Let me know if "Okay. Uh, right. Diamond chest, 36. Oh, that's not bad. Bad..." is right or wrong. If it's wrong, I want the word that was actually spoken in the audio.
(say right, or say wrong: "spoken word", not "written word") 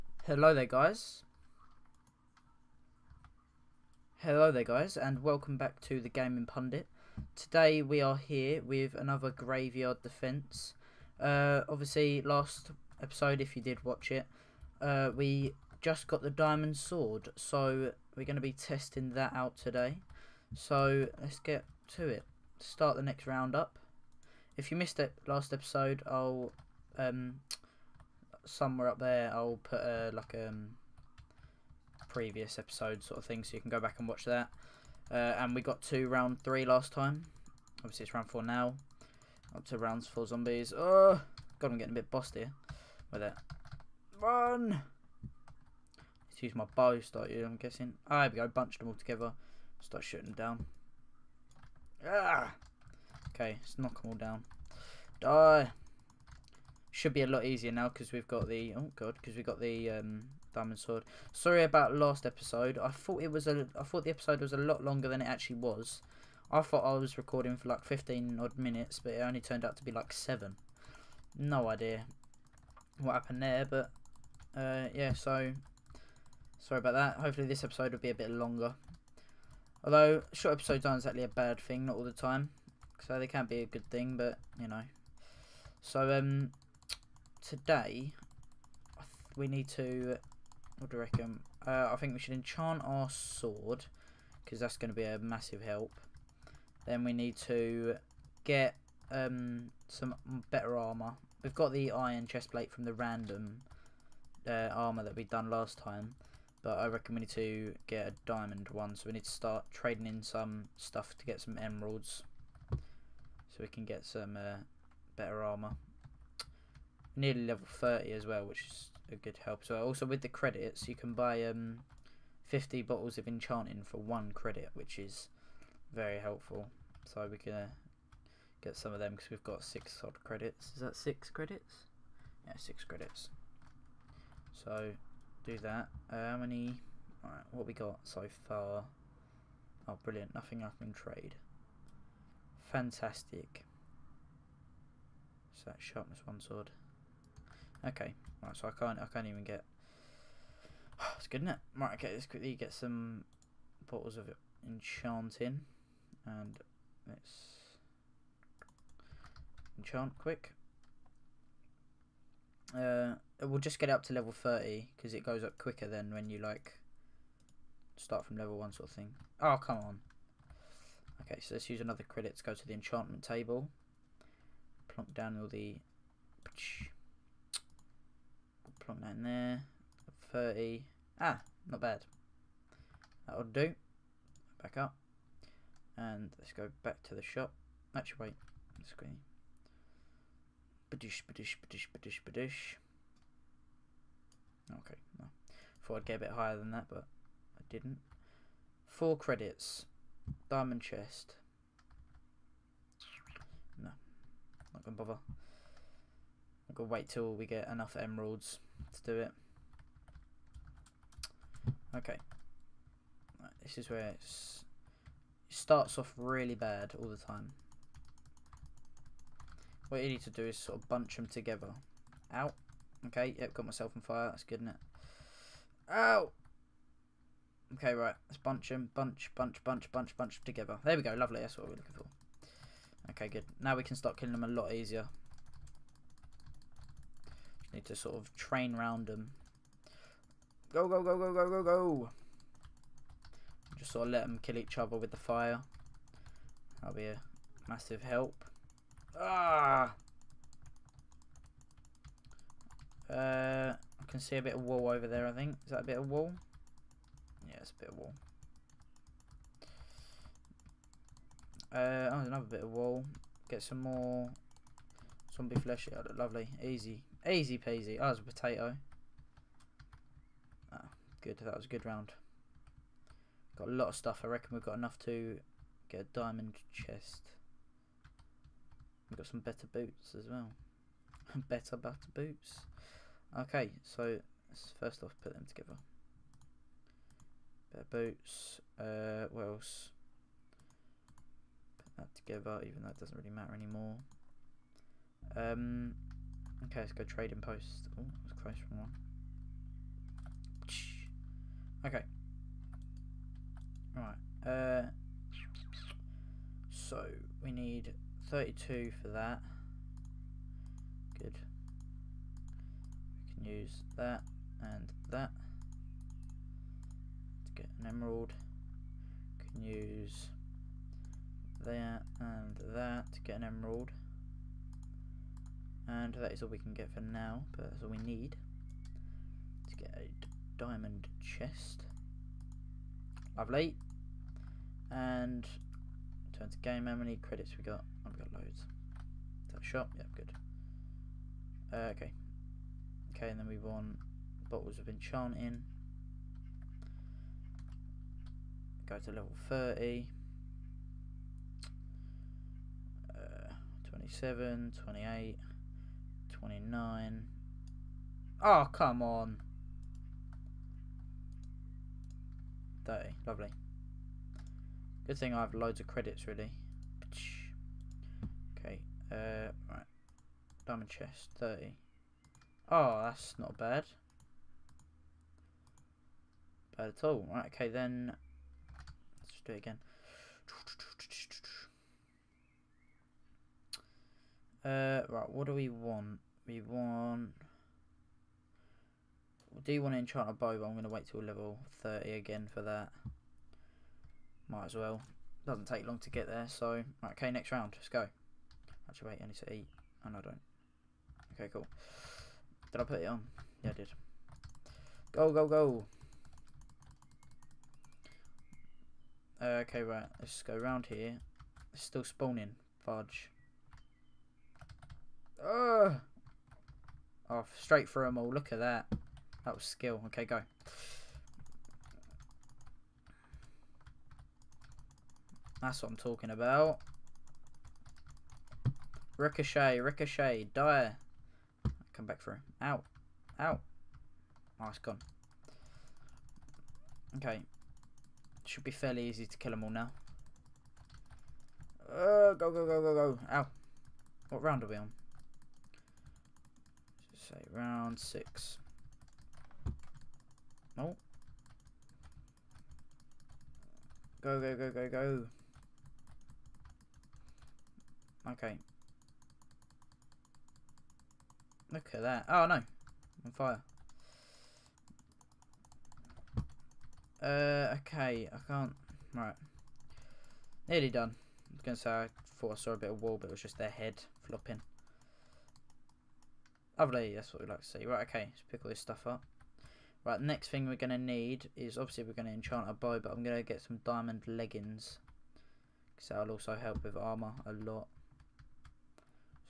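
wrong: "30", not "36".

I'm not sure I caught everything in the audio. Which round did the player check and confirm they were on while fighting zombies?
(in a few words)
round 6.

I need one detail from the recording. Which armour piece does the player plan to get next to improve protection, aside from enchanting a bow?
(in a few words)
diamond leggings.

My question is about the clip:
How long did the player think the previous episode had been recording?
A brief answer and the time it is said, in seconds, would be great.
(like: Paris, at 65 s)
15 minutes, at 67 s.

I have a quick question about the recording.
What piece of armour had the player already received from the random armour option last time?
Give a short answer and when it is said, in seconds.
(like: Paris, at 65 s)
iron chest plate, at 101 s.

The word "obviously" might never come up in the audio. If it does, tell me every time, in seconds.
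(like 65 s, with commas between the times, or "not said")
11 s, 37 s, 481 s.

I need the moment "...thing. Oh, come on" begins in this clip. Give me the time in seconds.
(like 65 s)
168 s.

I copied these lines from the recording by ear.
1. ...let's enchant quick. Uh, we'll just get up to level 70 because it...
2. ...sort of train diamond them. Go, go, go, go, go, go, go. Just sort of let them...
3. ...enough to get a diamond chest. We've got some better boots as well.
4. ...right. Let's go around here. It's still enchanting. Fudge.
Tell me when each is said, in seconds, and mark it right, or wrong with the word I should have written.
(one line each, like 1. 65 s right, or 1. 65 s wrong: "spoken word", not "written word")
1. 157 s wrong: "30", not "70"
2. 237 s wrong: "round", not "diamond"
3. 274 s right
4. 409 s wrong: "spawning", not "enchanting".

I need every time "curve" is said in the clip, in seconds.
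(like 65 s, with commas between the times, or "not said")
not said.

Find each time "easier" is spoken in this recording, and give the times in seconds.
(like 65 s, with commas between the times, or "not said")
57 s, 234 s.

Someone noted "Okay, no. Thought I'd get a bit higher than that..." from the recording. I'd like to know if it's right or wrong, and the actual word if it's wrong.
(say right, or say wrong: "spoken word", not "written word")
right.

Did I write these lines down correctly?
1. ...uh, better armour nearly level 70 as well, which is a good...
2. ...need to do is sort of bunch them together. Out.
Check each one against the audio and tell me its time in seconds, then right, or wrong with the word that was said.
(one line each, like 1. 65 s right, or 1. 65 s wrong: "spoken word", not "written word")
1. 114 s wrong: "30", not "70"
2. 220 s right.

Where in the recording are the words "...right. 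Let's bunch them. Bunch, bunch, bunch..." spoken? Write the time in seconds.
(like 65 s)
227 s.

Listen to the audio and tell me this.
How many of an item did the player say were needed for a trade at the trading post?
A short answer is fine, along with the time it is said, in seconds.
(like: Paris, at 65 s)
32, at 308 s.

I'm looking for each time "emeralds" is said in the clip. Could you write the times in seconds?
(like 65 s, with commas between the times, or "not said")
111 s, 207 s, 317 s, 323 s.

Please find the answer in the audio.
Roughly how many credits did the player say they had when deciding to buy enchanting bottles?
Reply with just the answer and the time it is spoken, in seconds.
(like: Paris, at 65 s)
6, at 129 s.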